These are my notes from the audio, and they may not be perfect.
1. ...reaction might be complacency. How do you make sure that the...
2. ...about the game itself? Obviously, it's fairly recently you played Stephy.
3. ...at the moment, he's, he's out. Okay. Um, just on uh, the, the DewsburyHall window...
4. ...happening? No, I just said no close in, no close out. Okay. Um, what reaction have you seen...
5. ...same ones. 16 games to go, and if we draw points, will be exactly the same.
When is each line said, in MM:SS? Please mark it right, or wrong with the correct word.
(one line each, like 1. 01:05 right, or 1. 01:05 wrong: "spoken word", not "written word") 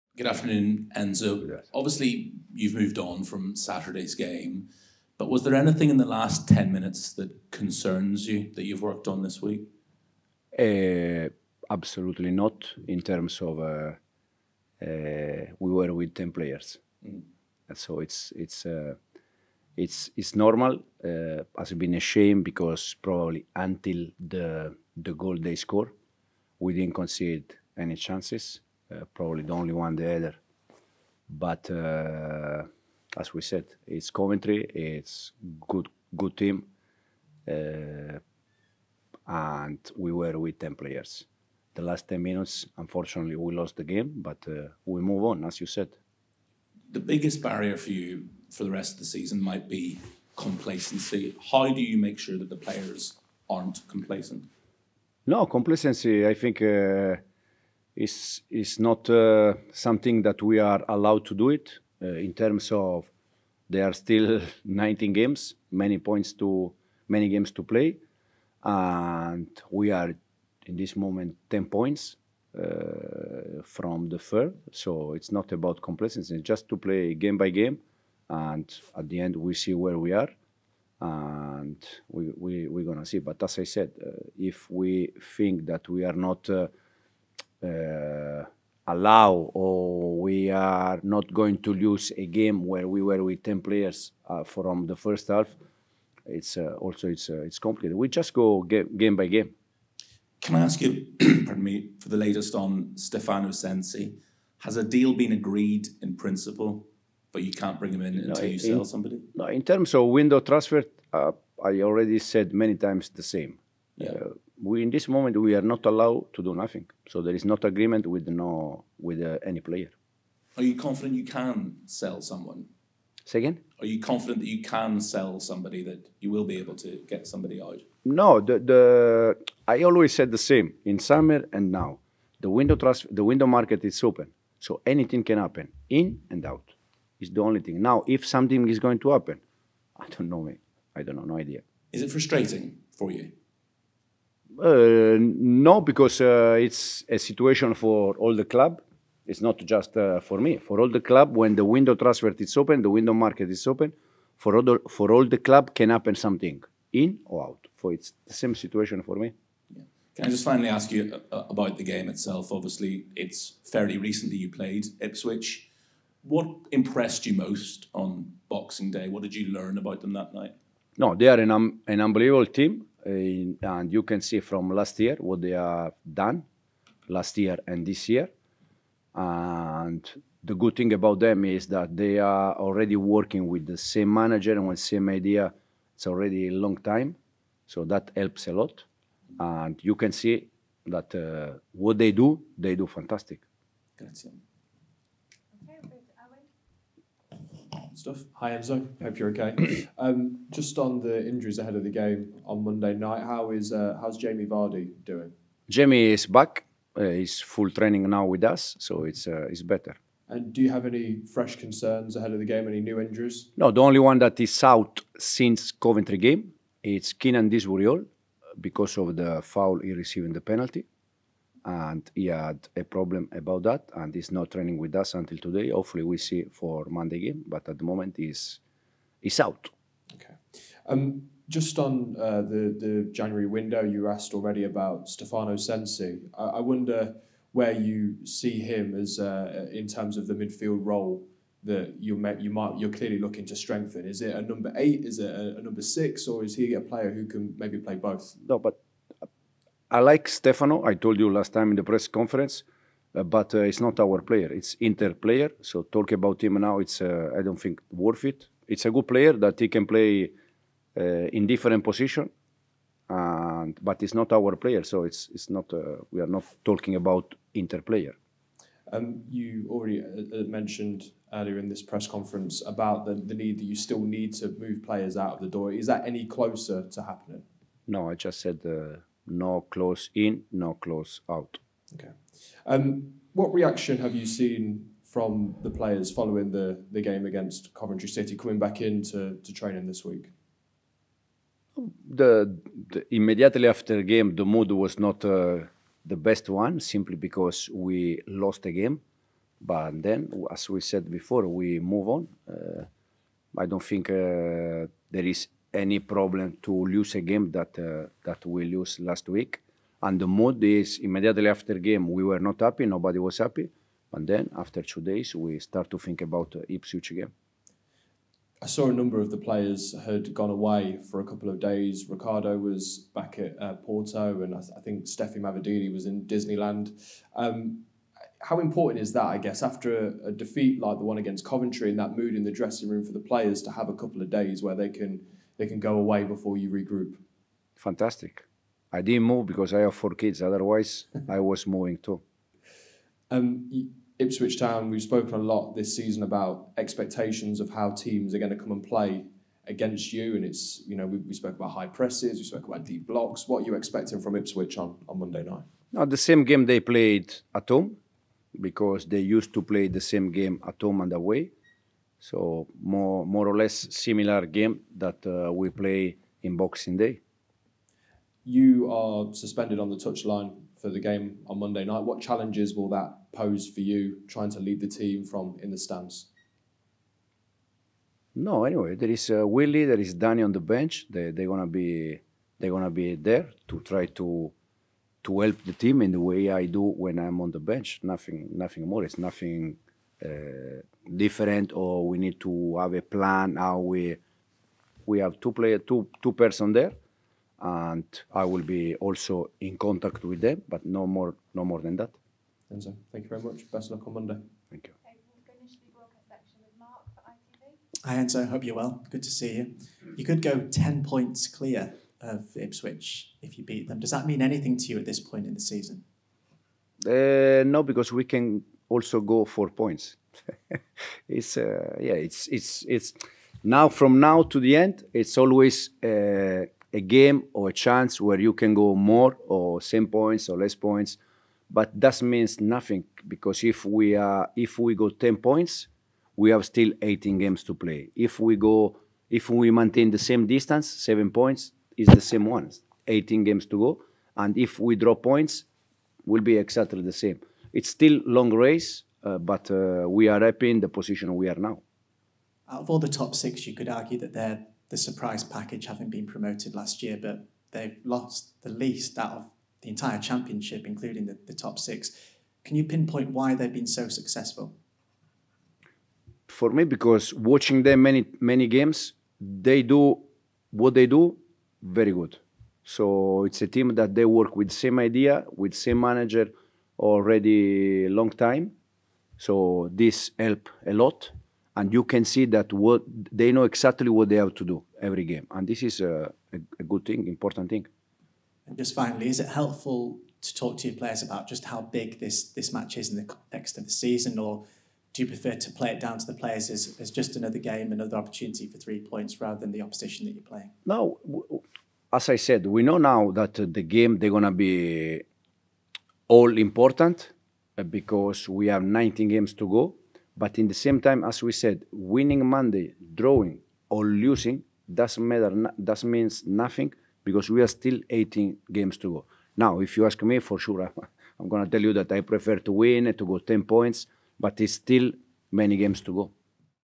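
1. 00:49 wrong: "season", not "reaction"
2. 02:41 wrong: "Ipswich", not "Stephy"
3. 03:47 wrong: "January", not "DewsburyHall"
4. 04:37 right
5. 07:22 wrong: "18", not "16".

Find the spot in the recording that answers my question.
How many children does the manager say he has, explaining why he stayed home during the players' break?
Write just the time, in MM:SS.
05:39.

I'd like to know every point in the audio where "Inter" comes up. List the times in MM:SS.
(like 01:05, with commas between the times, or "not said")
04:14, 04:27.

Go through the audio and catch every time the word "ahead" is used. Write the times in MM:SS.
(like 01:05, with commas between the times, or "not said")
03:21, 03:32.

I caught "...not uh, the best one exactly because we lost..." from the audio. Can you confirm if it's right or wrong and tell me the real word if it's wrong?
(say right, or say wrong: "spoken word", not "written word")
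wrong: "simply", not "exactly".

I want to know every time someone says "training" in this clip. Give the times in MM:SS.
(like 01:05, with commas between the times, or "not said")
03:27, 03:44, 04:49.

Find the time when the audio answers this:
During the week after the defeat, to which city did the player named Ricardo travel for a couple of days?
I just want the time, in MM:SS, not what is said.
05:23.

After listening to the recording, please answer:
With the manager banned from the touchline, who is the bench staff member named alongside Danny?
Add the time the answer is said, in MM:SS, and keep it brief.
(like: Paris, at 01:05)
Willie, at 06:19.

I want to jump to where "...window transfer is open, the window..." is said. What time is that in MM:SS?
02:31.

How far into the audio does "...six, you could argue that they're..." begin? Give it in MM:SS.
07:33.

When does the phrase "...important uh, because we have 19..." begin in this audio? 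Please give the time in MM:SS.
08:26.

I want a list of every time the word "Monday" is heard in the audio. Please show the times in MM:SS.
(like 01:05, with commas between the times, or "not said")
03:22, 03:46, 05:55, 06:11, 06:44, 08:32.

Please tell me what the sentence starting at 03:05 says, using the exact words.
It's already a long time, so that helps a lot.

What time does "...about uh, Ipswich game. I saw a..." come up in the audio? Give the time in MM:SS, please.
05:16.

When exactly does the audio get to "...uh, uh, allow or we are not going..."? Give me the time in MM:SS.
01:26.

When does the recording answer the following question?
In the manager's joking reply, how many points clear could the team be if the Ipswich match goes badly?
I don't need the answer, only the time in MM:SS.
06:59.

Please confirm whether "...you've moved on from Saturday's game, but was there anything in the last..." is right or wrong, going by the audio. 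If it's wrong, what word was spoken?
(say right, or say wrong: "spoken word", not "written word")
right.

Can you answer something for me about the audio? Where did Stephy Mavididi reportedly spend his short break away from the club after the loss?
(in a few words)
Disneyland.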